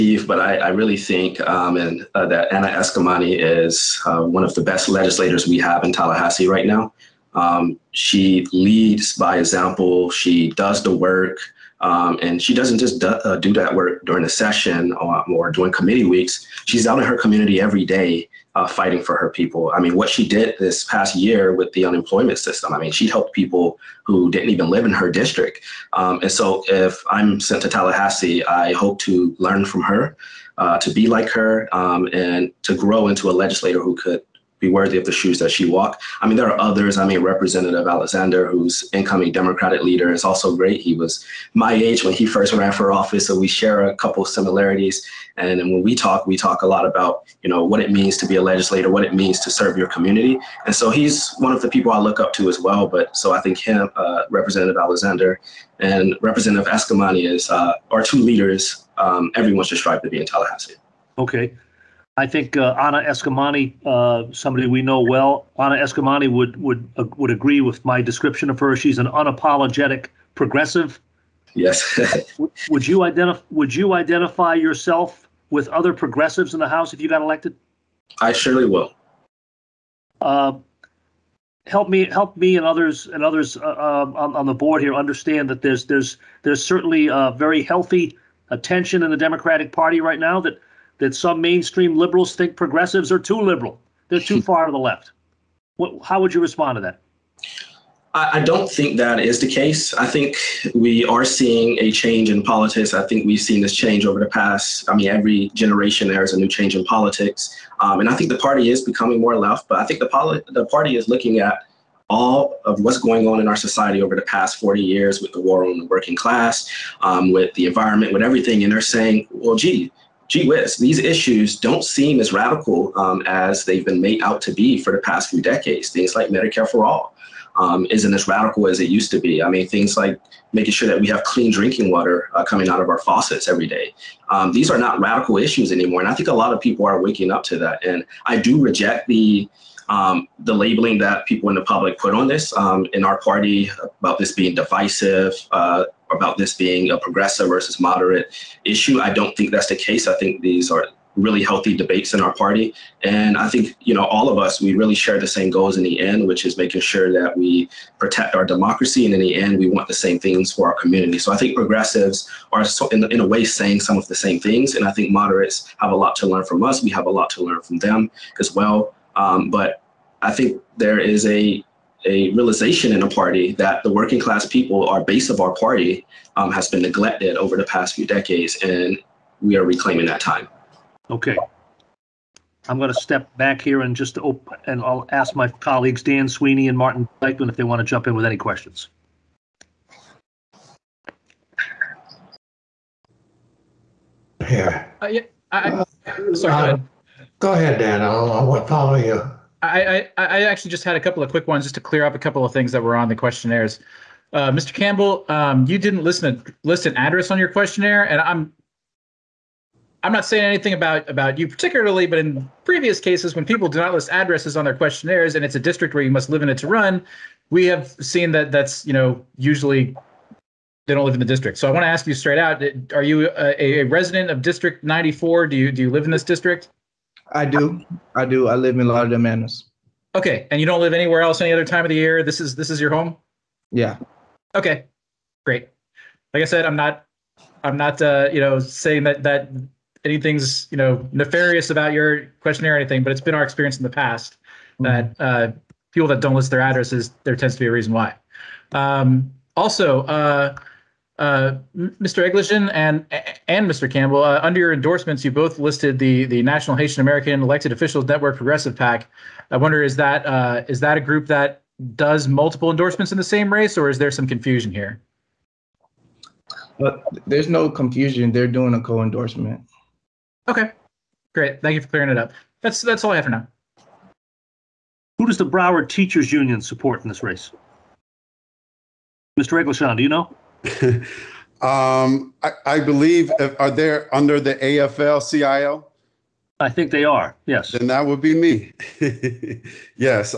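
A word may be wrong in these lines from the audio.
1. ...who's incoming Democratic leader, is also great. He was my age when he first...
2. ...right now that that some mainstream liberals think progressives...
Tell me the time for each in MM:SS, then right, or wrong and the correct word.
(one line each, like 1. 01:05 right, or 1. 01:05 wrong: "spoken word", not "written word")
1. 00:38 right
2. 01:30 right.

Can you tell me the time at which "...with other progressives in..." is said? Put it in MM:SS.
01:15.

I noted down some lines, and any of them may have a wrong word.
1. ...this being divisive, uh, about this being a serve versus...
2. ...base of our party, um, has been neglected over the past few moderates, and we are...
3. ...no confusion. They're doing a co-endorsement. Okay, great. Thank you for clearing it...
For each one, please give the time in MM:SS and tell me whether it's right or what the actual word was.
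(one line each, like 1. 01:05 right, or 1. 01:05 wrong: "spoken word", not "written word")
1. 02:24 wrong: "progressive", not "serve"
2. 02:55 wrong: "decades", not "moderates"
3. 04:27 right.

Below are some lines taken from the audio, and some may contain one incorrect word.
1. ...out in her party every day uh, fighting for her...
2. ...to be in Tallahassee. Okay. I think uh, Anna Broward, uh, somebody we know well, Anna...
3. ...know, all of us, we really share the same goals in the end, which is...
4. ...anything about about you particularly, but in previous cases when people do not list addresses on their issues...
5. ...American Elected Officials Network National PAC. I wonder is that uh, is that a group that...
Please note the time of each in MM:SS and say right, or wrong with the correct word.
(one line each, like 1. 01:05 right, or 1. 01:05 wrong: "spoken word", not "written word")
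1. 00:16 wrong: "community", not "party"
2. 01:00 wrong: "Eskamani", not "Broward"
3. 02:33 right
4. 03:30 wrong: "questionnaires", not "issues"
5. 04:17 wrong: "Progressive", not "National".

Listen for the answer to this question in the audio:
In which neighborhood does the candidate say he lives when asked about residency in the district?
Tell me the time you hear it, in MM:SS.
03:48.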